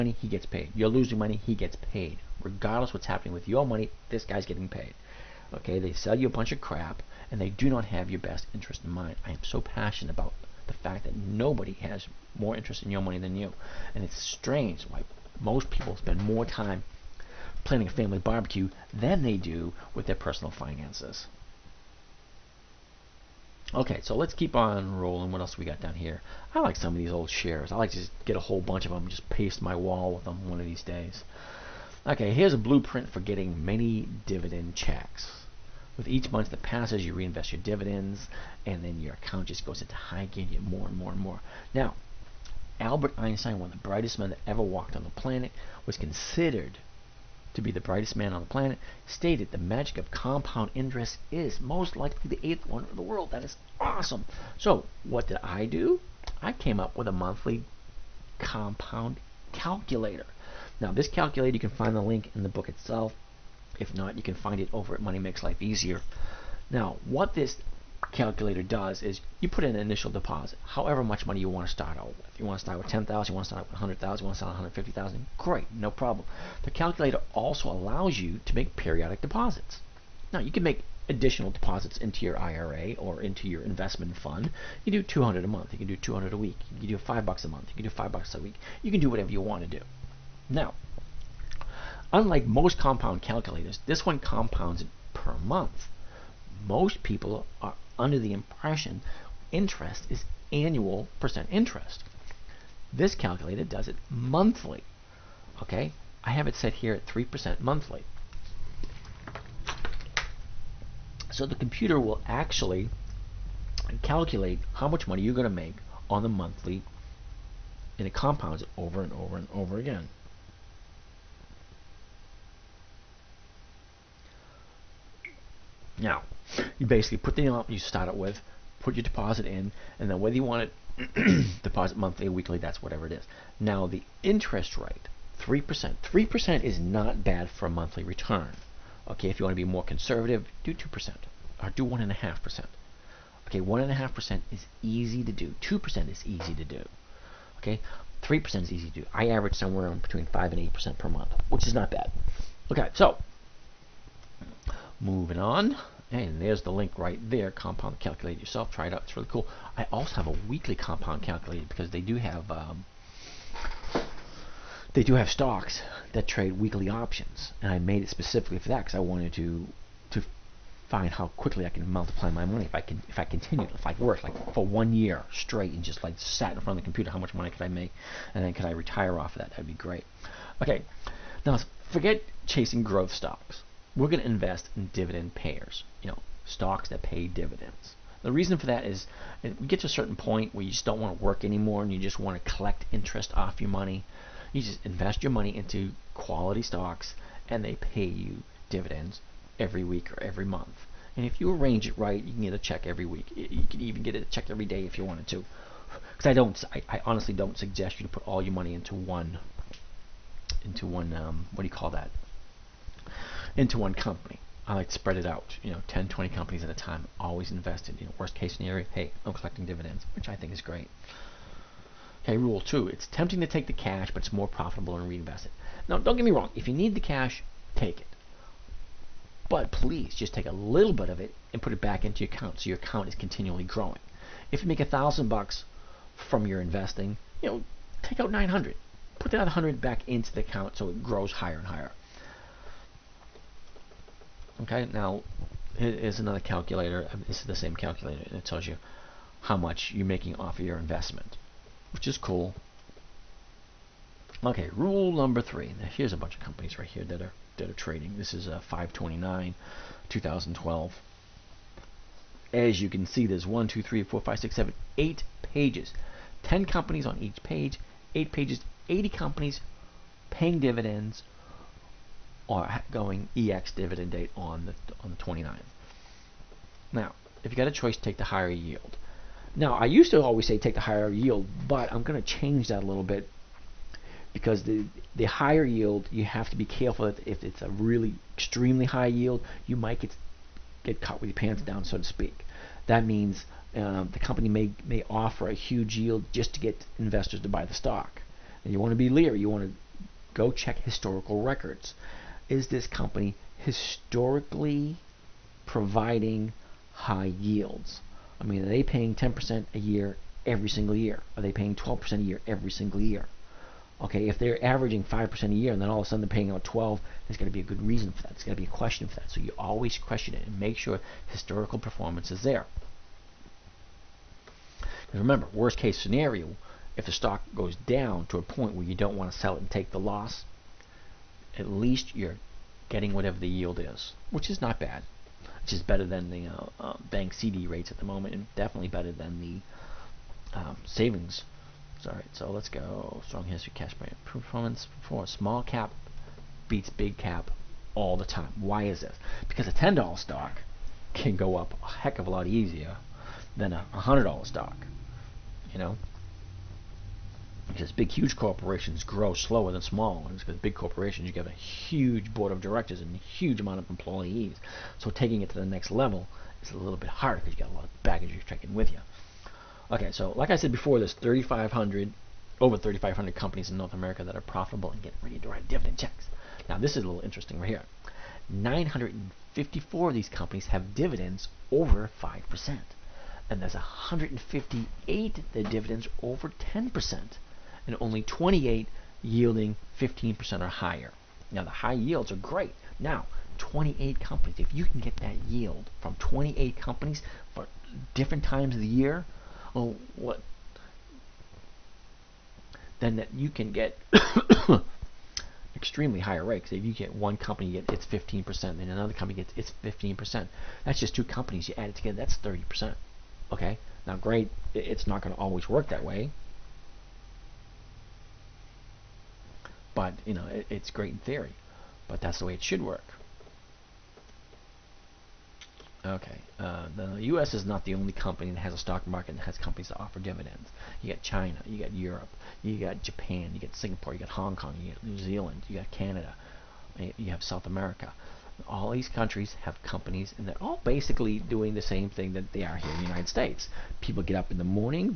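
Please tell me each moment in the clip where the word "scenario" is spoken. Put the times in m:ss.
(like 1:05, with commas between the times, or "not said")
3:38, 5:26.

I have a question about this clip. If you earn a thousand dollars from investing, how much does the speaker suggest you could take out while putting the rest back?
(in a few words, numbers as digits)
900.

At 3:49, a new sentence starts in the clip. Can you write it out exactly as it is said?
But please just take a little bit of it and put it back into your account so your account is continually growing.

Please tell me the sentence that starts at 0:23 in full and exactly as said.
Okay, so let's keep on rolling.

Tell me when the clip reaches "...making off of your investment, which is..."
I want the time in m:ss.
4:10.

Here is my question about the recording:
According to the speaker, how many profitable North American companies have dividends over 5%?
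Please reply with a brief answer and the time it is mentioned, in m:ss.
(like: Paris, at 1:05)
954, at 6:18.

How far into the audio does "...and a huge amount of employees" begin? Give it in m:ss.
6:02.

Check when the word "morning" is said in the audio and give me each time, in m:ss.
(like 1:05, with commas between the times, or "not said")
7:24.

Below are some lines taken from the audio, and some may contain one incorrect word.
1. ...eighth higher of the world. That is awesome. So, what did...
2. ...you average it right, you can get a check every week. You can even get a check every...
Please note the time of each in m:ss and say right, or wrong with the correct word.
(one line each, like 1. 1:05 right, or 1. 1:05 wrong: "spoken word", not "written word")
1. 0:52 wrong: "wonder", not "higher"
2. 3:21 wrong: "arrange", not "average".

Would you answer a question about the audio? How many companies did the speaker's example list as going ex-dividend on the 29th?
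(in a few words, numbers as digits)
80.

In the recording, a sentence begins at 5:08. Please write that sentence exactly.
I mean, are they paying 10% a year every single year?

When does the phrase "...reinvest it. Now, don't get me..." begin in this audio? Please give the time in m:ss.
3:45.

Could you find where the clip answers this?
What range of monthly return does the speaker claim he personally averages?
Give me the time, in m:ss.
2:29.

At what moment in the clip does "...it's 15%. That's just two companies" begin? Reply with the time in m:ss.
6:49.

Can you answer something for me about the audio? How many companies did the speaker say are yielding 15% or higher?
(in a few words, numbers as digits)
28.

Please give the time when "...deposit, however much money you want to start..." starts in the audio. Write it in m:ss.
1:10.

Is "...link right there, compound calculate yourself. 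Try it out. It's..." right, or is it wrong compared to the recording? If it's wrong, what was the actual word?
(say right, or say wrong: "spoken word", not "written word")
right.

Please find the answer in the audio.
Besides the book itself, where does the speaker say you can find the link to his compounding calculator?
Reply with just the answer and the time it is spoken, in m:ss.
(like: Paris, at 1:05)
Money Makes Life Easier, at 1:05.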